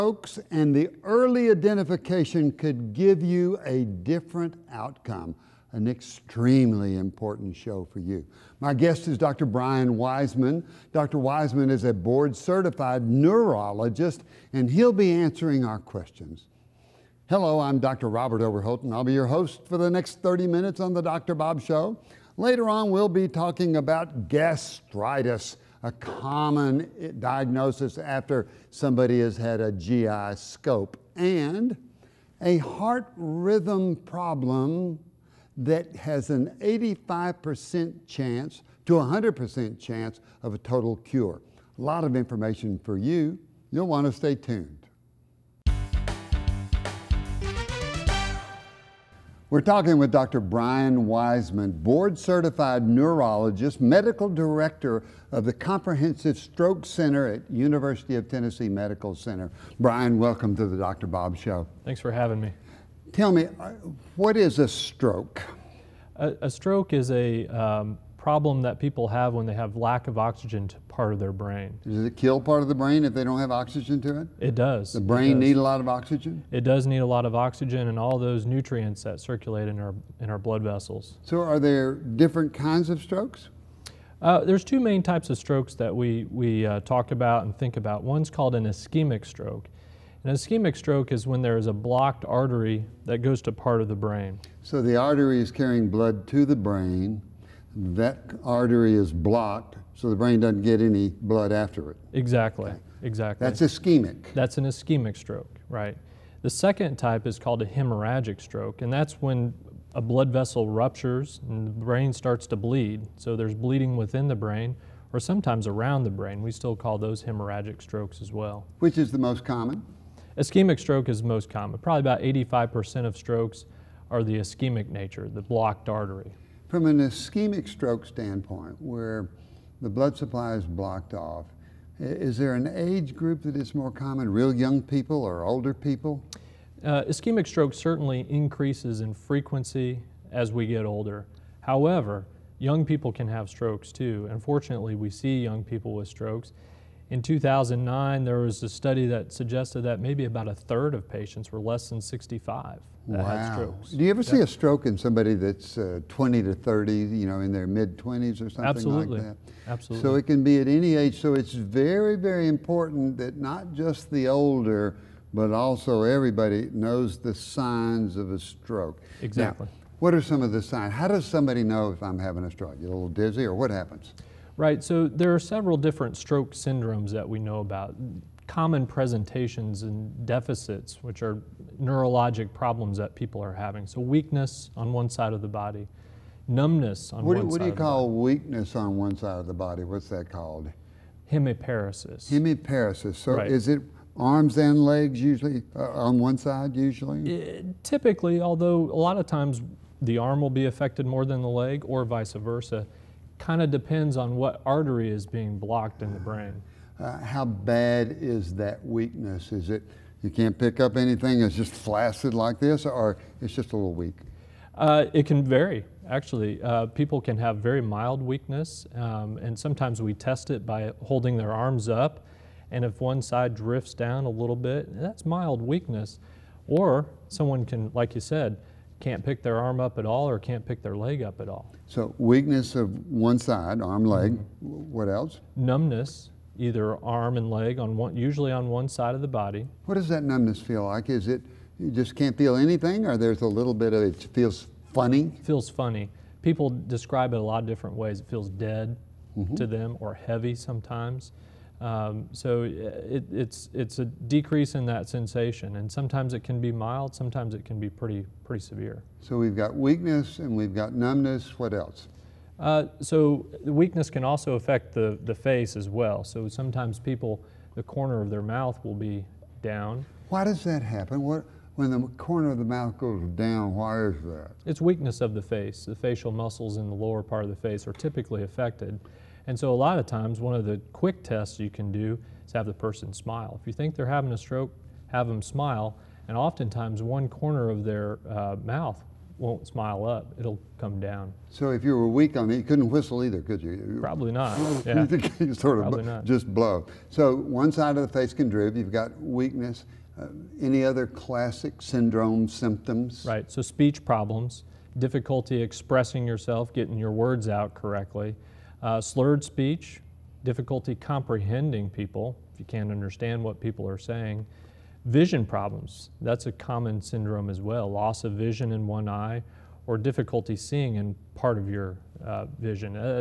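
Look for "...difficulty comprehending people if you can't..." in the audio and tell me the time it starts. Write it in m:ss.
5:10.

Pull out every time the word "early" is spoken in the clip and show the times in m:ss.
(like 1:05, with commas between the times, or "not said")
0:01.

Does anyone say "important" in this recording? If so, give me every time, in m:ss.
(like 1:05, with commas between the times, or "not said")
0:06, 2:42.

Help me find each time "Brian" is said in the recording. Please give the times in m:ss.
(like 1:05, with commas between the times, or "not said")
0:09, 0:50, 0:59.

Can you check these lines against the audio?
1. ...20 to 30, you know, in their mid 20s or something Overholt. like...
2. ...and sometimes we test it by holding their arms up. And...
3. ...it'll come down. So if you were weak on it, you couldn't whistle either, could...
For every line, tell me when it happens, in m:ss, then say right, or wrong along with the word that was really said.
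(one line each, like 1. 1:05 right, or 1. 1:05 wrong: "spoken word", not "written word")
1. 2:36 wrong: "Absolutely", not "Overholt"
2. 3:39 right
3. 4:50 right.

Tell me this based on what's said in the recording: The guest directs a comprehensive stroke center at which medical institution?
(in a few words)
University of Tennessee Medical Center.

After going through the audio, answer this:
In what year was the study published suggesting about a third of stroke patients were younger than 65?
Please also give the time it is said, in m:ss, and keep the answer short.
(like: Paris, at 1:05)
2009, at 2:27.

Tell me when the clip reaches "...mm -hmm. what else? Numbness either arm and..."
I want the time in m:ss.
3:54.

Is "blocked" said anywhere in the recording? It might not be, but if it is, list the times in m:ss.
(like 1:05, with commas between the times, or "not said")
1:31, 1:39, 2:05, 2:10, 3:25.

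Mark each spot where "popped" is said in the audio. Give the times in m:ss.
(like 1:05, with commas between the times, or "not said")
not said.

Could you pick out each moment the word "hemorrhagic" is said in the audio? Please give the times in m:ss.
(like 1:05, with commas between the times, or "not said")
1:47, 1:57.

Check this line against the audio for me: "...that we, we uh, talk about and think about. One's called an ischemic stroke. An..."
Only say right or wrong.
right.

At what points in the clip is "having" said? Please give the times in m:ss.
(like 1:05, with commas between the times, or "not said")
1:02, 2:52, 3:03, 4:44.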